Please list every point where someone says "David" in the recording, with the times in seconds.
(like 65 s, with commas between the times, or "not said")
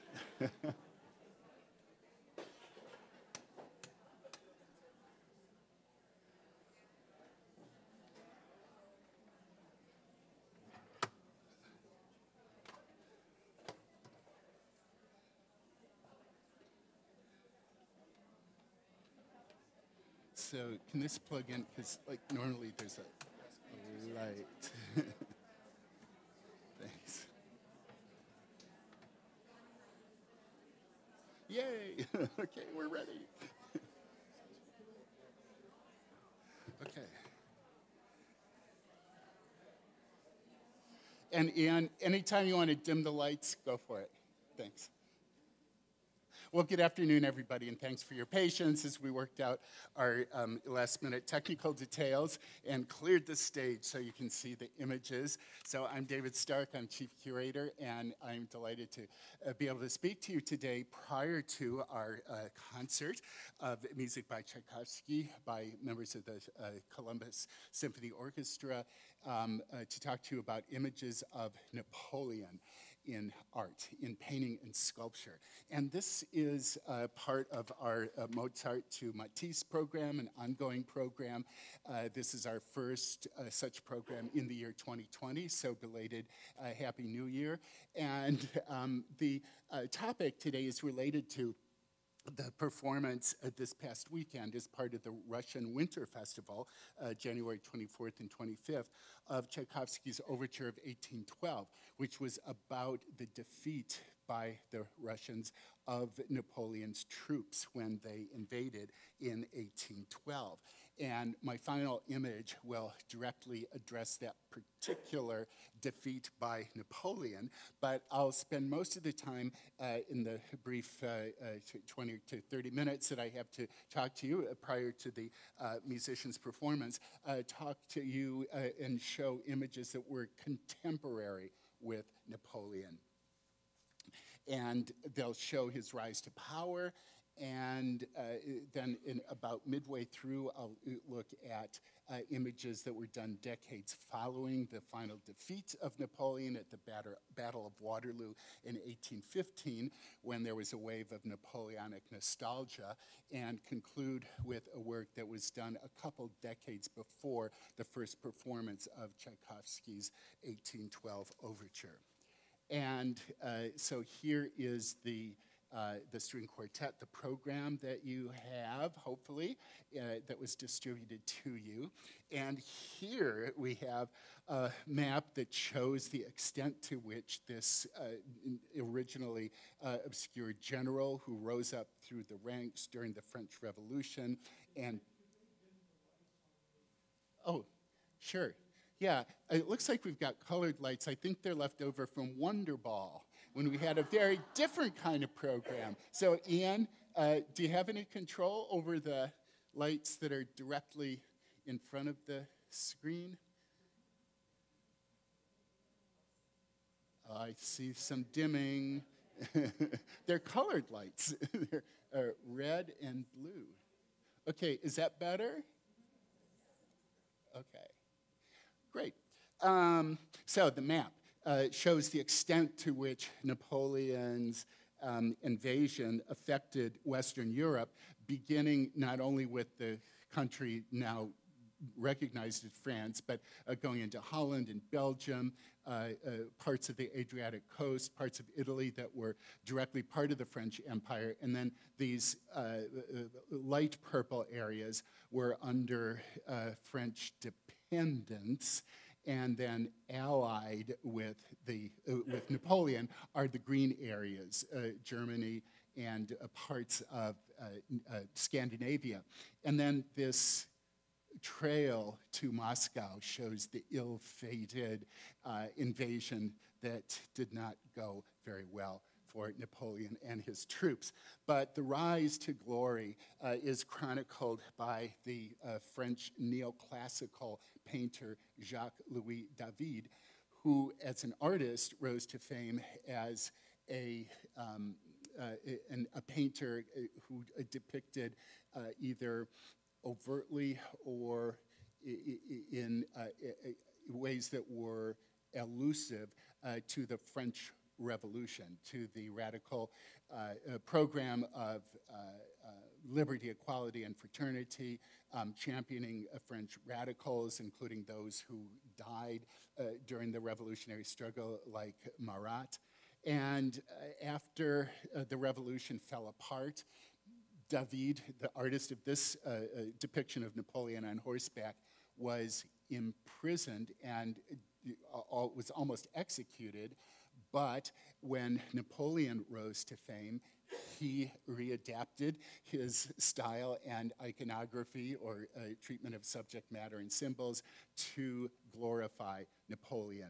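56 s, 279 s, 317 s.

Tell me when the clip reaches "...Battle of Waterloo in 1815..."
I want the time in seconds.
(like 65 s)
147 s.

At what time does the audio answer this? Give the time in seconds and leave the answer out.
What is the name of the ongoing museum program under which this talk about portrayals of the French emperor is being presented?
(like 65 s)
78 s.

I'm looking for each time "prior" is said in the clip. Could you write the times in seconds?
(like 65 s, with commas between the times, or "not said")
61 s, 124 s.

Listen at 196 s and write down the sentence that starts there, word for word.
So, Ian, uh, do you have any control over the lights that are directly in front of the screen?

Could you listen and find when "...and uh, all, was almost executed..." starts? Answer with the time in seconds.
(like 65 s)
324 s.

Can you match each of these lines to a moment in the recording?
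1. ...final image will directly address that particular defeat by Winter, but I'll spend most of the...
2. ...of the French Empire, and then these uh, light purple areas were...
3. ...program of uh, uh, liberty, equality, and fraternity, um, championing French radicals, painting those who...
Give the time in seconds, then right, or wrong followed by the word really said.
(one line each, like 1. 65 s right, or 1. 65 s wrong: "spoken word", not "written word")
1. 111 s wrong: "Napoleon", not "Winter"
2. 240 s right
3. 300 s wrong: "including", not "painting".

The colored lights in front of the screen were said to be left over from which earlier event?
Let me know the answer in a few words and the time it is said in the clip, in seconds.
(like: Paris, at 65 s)
Wonder Ball, at 192 s.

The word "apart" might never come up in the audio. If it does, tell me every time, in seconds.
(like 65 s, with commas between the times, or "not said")
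316 s.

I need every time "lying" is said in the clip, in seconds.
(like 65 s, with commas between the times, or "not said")
not said.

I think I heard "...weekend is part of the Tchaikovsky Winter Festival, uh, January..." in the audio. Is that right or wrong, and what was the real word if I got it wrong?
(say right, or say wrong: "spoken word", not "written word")
wrong: "Russian", not "Tchaikovsky".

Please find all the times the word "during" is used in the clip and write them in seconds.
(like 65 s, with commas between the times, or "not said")
182 s, 310 s.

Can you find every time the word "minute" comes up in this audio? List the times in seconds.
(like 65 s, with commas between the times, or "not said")
51 s, 122 s.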